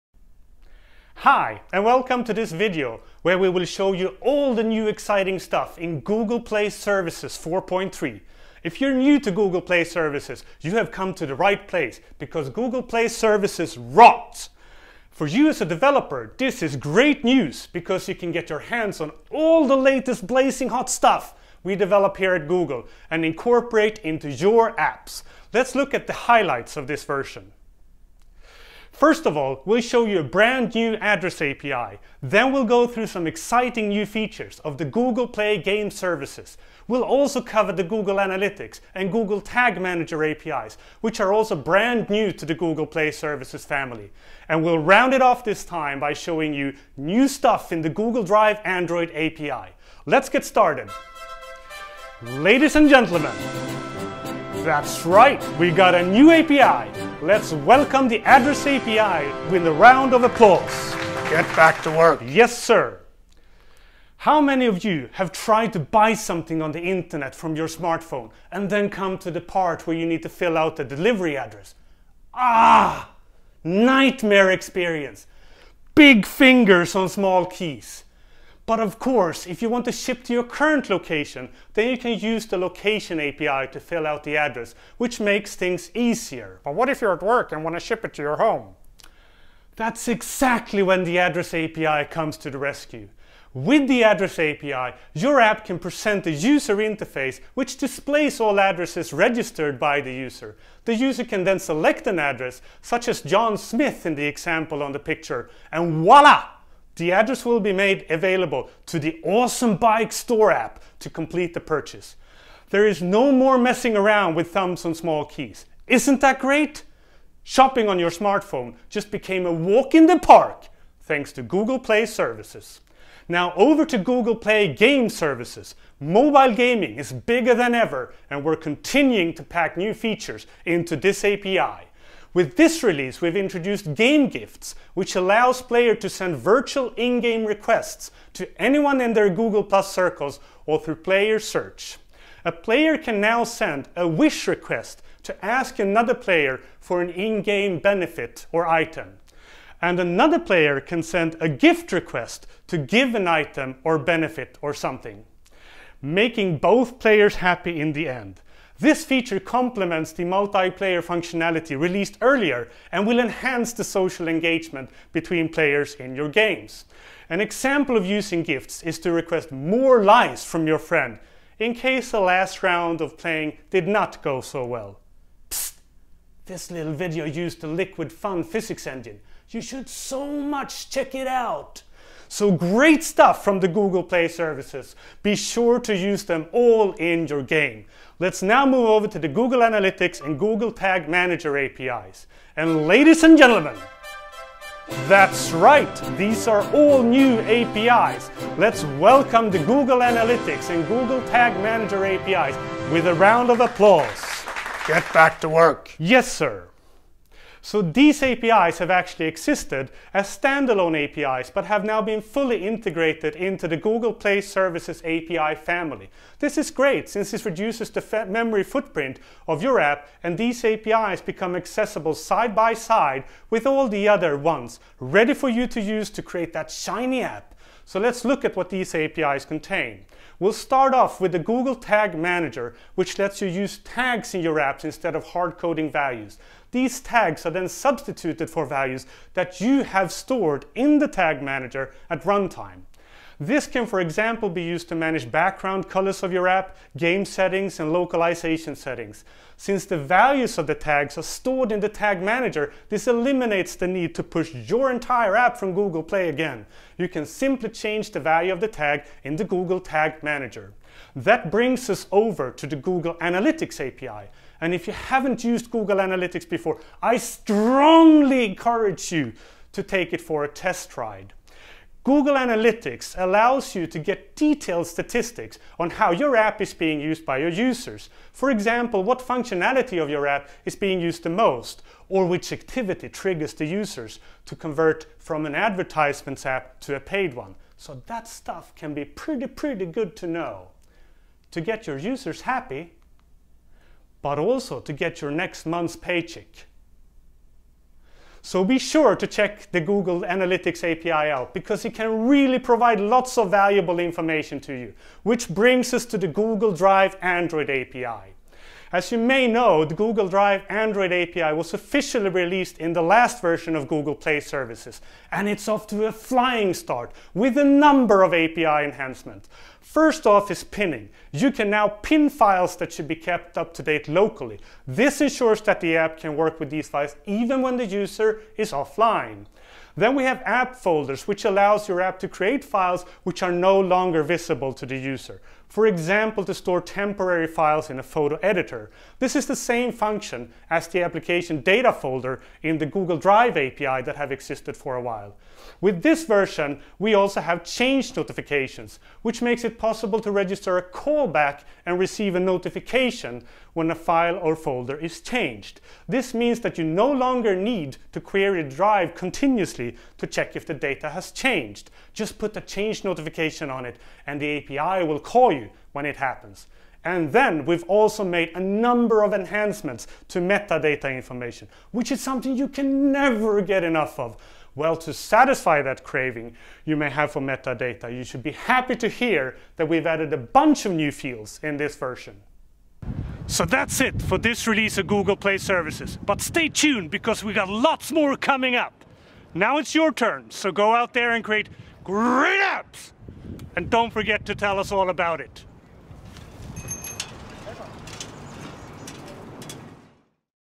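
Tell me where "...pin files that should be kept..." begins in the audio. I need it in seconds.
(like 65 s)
321 s.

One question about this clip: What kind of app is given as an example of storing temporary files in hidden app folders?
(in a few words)
photo editor.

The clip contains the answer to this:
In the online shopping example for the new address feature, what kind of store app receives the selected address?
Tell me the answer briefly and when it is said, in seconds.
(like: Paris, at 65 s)
bike store, at 109 s.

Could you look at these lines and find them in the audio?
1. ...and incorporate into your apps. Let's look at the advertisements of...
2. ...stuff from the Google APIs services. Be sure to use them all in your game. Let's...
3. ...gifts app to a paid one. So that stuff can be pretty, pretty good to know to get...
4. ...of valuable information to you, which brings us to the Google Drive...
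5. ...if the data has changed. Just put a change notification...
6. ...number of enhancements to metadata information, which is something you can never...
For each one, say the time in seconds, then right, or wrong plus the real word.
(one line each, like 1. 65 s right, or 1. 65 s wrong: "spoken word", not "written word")
1. 23 s wrong: "highlights", not "advertisements"
2. 183 s wrong: "Play", not "APIs"
3. 285 s wrong: "advertisements", not "gifts"
4. 303 s right
5. 360 s right
6. 368 s right.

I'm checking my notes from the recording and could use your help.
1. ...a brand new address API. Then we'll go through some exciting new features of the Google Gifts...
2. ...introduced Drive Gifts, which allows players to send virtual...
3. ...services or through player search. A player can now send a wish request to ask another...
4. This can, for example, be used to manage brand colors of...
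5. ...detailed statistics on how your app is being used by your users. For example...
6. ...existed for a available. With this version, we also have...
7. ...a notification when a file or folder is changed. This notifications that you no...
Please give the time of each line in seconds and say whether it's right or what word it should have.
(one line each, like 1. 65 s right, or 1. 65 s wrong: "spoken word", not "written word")
1. 30 s wrong: "Play", not "Gifts"
2. 133 s wrong: "Game", not "Drive"
3. 139 s wrong: "circles", not "services"
4. 243 s wrong: "background", not "brand"
5. 274 s right
6. 344 s wrong: "while", not "available"
7. 352 s wrong: "means", not "notifications".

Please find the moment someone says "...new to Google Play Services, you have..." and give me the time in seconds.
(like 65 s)
8 s.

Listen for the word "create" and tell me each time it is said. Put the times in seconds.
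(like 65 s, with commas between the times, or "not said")
226 s, 332 s, 391 s.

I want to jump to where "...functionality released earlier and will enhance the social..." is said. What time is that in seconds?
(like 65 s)
161 s.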